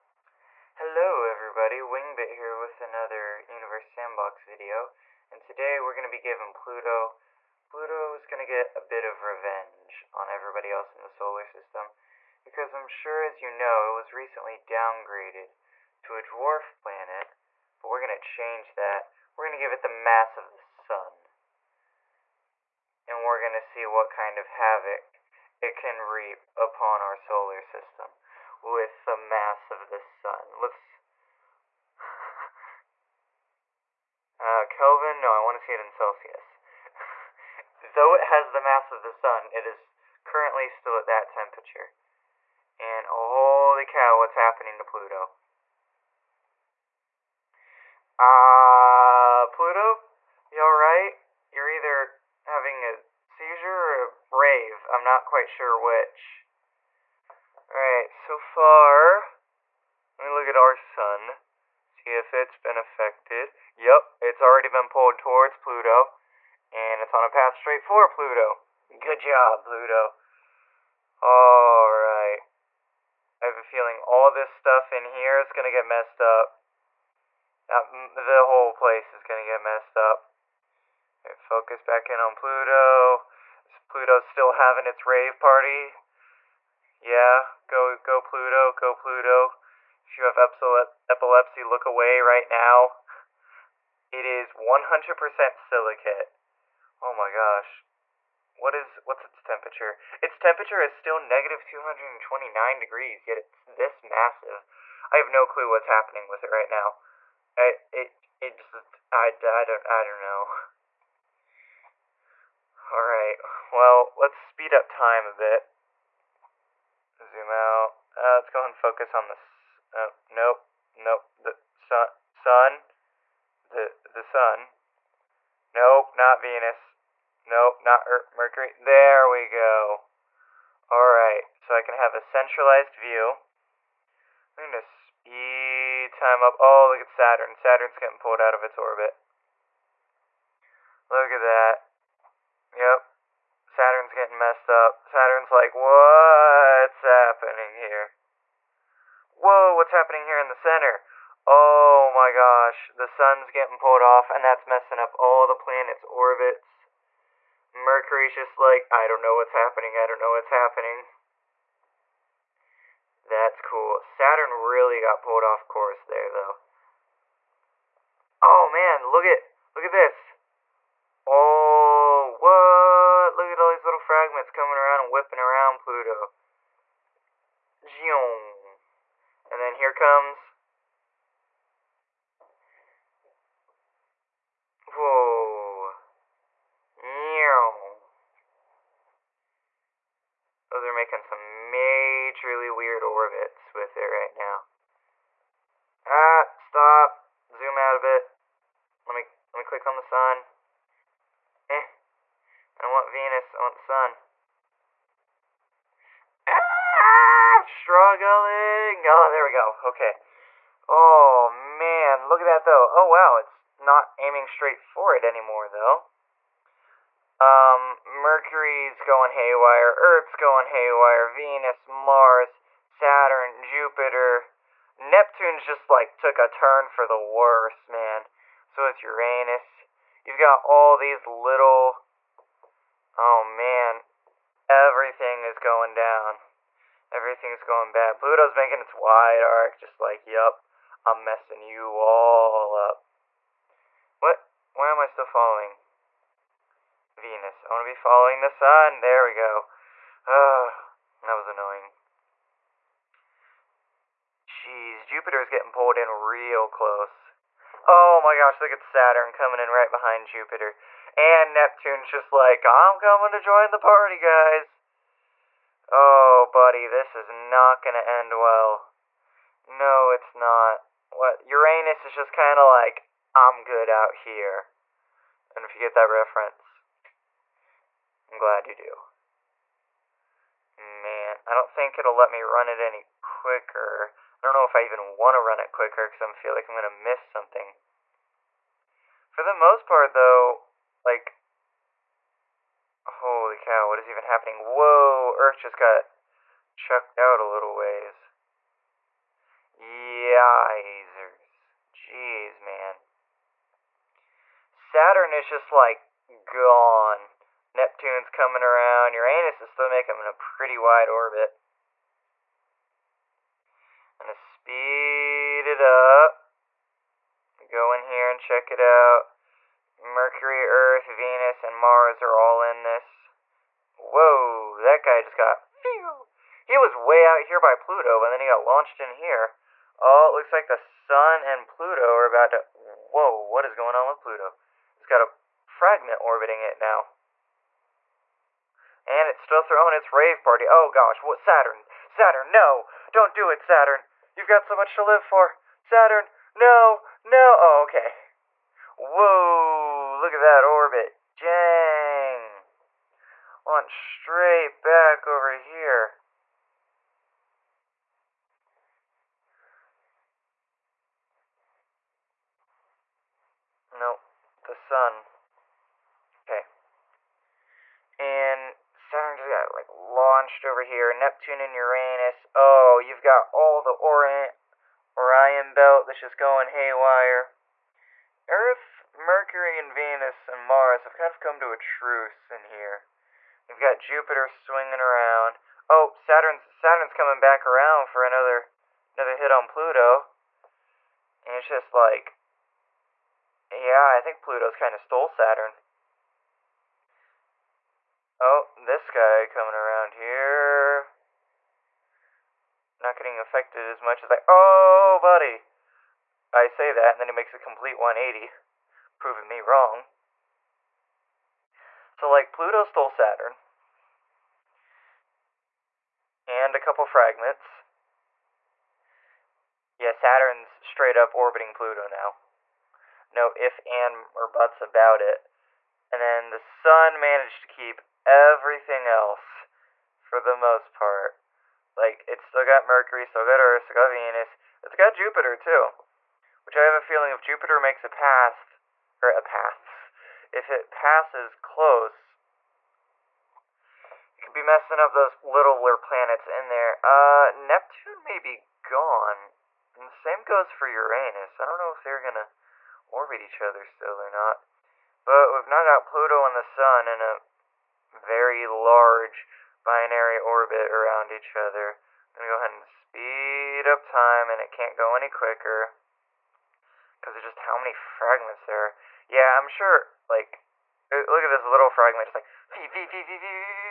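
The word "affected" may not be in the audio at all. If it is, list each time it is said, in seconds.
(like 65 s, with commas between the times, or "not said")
62 s, 403 s.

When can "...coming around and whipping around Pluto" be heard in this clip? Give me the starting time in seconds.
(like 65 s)
174 s.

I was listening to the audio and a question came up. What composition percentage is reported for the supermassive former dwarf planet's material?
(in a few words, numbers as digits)
100% silicate.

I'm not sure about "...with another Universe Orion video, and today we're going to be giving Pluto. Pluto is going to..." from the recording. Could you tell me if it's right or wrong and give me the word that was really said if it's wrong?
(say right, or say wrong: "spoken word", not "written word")
wrong: "Sandbox", not "Orion".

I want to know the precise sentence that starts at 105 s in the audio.
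I have no clue what's happening with it right now.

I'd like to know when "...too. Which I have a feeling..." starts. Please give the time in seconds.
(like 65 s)
435 s.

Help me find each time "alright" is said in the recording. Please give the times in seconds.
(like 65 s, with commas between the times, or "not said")
50 s, 57 s, 71 s, 112 s, 130 s.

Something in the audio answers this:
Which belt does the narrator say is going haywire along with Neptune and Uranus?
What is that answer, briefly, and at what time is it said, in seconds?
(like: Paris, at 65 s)
Orion belt, at 373 s.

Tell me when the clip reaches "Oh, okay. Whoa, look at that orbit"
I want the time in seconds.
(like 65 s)
347 s.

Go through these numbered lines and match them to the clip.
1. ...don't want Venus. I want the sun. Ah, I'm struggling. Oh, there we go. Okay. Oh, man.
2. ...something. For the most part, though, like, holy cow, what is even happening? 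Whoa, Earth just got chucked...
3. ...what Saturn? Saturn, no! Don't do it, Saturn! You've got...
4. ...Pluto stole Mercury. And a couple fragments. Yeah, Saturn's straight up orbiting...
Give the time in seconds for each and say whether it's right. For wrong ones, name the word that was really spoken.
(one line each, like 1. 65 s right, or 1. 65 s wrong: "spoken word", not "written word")
1. 202 s right
2. 287 s right
3. 341 s right
4. 412 s wrong: "Saturn", not "Mercury".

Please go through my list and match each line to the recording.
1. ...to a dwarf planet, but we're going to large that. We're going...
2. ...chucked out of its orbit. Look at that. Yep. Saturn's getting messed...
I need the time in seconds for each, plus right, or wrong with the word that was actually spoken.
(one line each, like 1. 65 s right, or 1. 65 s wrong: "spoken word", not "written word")
1. 16 s wrong: "change", not "large"
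2. 138 s wrong: "pulled", not "chucked".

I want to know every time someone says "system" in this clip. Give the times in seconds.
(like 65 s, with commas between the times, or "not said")
11 s, 27 s.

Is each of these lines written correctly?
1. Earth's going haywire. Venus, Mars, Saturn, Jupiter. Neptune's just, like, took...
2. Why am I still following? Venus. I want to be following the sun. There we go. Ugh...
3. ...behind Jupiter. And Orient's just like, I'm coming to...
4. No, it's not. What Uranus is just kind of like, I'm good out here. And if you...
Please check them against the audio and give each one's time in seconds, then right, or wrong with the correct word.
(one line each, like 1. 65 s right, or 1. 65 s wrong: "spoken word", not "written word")
1. 219 s right
2. 244 s right
3. 259 s wrong: "Neptune", not "Orient"
4. 269 s right.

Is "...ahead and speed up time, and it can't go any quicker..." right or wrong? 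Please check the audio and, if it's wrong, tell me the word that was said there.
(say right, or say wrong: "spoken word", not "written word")
right.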